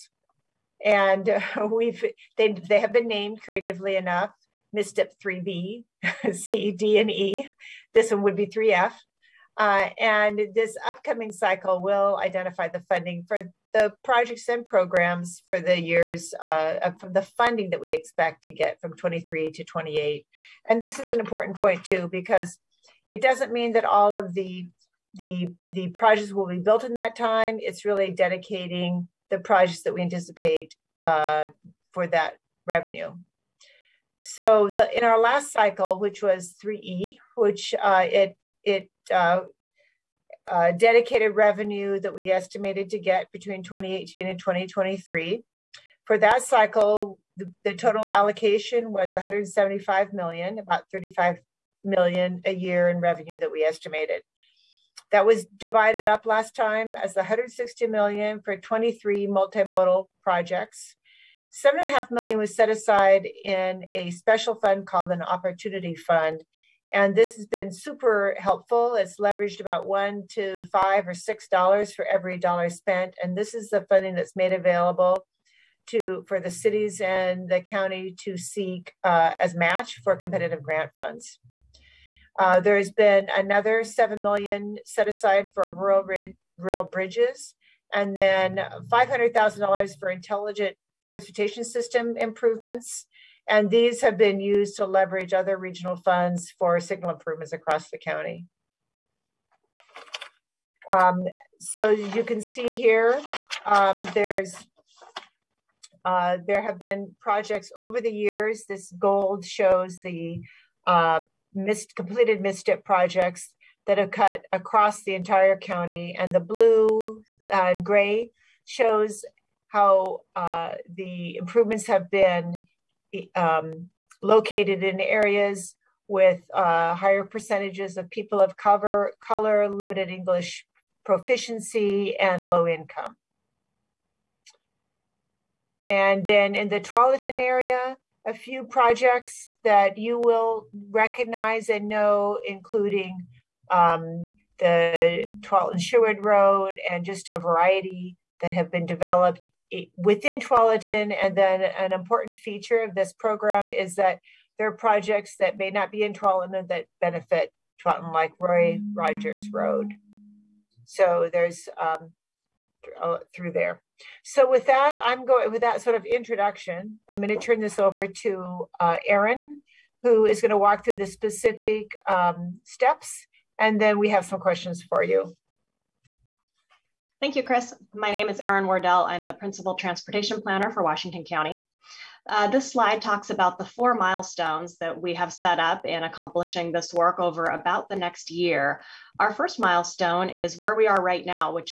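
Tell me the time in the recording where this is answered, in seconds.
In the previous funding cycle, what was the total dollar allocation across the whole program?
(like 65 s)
49 s.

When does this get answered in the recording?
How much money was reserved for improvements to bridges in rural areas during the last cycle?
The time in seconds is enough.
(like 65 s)
83 s.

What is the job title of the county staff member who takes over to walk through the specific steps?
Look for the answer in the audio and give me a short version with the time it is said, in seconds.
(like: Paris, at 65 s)
Principal Transportation Planner, at 179 s.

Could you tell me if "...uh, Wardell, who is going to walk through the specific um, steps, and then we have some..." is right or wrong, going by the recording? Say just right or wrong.
wrong.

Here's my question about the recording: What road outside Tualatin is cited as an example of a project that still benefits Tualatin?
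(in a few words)
Roy Rogers Road.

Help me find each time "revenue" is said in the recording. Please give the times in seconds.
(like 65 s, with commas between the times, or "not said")
32 s, 41 s, 52 s.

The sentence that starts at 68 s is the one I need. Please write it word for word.
It's leveraged about one to five or six dollars for every dollar spent.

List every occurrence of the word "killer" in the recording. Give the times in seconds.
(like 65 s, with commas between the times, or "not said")
not said.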